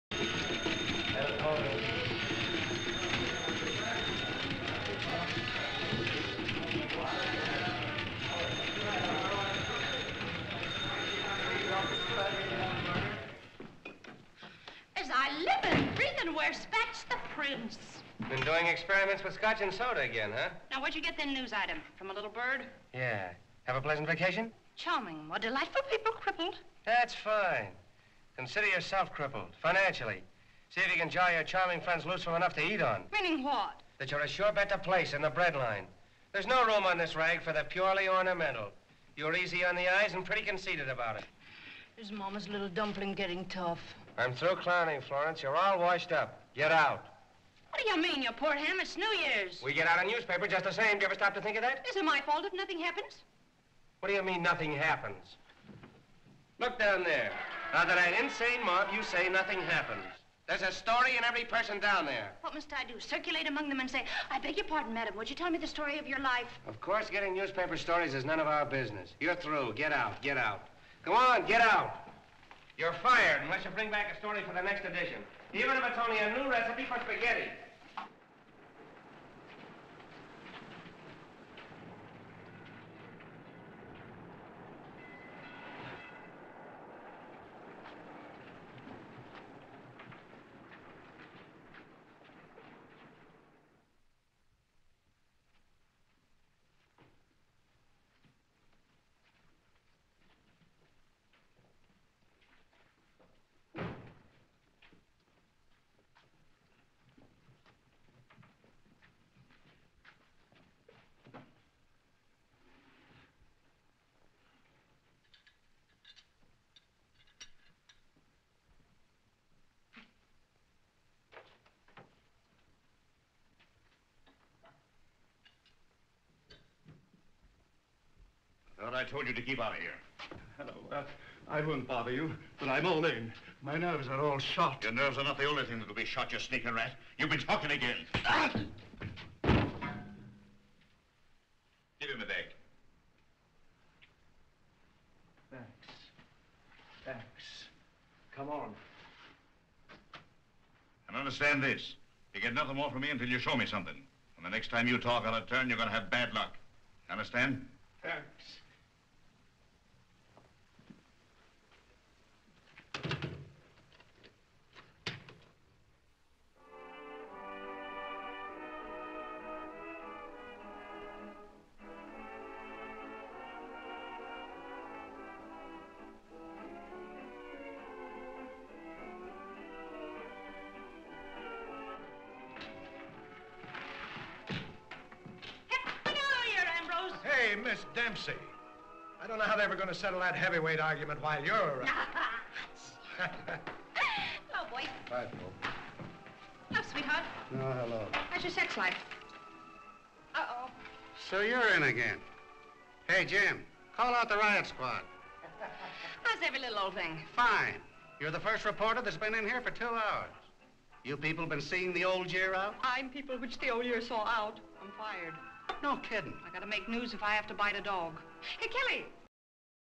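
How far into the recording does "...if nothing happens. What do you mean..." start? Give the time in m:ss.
0:52.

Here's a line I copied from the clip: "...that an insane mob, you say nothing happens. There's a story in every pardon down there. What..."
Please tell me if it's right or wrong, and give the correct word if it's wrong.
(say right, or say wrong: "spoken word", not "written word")
wrong: "person", not "pardon".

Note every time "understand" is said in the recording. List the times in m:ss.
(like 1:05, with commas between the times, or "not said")
2:31, 2:37.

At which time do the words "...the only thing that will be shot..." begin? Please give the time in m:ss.
2:15.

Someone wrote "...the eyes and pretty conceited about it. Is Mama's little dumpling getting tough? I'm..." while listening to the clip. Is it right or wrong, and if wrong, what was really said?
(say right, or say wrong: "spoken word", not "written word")
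right.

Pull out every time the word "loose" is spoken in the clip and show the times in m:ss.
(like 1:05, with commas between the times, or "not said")
0:32.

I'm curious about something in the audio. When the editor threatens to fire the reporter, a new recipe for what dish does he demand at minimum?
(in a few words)
Spaghetti.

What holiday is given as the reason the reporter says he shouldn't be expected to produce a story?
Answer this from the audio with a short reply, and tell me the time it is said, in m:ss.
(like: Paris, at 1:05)
New Year's, at 0:48.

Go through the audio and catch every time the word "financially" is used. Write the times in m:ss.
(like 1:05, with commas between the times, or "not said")
0:29.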